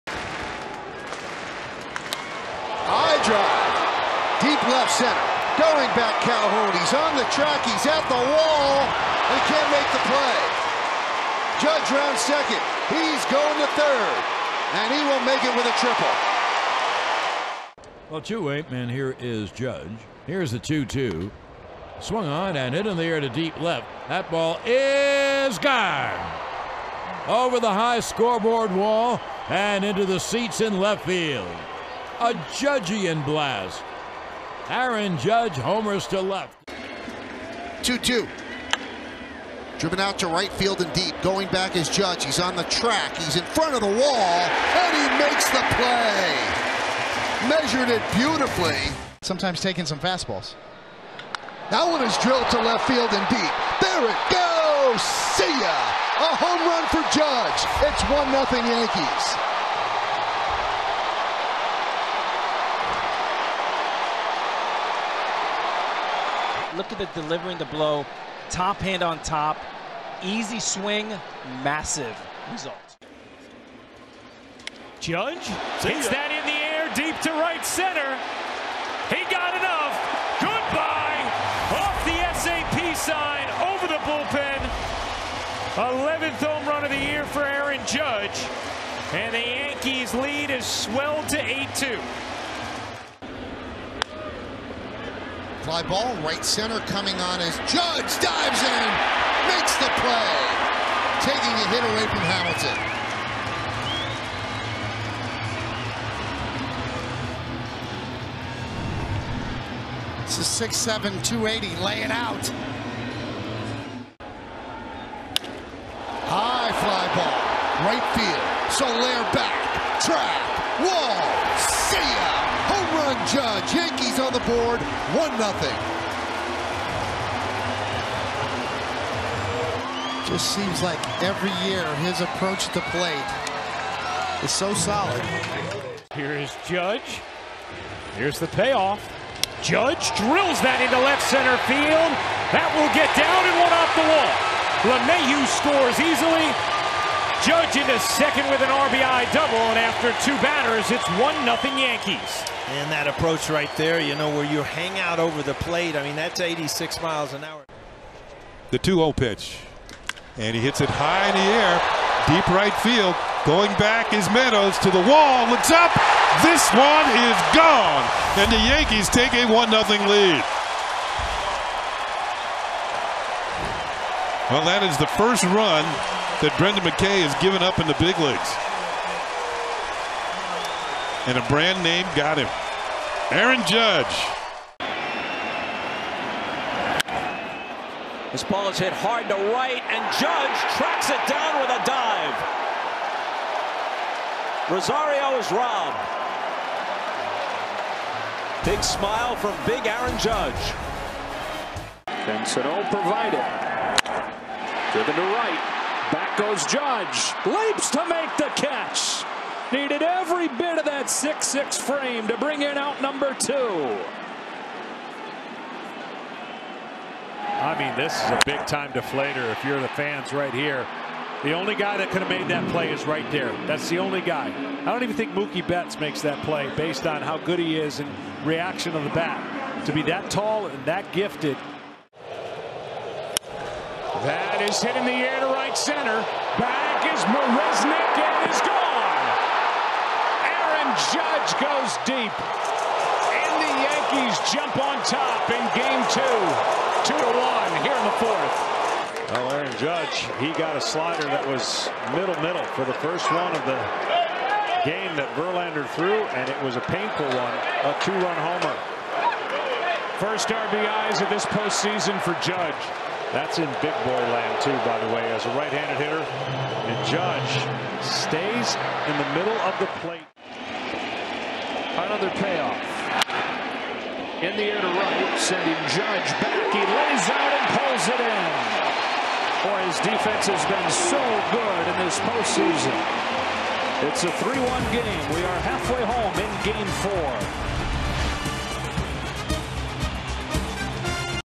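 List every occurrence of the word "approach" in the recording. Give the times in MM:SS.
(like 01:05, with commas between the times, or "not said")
02:12, 02:33.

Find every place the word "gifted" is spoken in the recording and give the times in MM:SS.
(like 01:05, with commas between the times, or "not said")
03:51.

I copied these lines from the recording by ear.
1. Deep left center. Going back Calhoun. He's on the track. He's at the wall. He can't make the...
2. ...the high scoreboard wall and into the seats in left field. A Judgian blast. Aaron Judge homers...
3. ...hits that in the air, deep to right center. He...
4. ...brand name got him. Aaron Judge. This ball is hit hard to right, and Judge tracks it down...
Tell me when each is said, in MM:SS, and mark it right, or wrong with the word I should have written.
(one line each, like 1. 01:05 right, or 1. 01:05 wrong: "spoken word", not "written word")
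1. 00:04 right
2. 00:27 right
3. 01:15 right
4. 03:01 right.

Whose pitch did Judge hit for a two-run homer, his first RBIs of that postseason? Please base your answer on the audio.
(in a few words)
Verlander.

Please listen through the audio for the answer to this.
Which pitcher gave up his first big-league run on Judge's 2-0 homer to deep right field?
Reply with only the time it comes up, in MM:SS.
02:56.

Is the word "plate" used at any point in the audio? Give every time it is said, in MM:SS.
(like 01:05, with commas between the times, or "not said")
02:12, 02:35, 04:30.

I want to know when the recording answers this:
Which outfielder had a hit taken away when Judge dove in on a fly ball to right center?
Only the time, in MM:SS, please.
01:42.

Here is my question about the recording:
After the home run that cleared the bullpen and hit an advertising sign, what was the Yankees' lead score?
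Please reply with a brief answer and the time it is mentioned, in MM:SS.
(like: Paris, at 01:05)
8-2, at 01:31.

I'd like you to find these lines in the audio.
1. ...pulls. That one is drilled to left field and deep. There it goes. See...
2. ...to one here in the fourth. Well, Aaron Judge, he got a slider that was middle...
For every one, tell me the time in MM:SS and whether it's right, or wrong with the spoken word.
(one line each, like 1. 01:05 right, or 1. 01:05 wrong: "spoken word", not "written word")
1. 00:49 wrong: "fastballs", not "pulls"
2. 04:07 right.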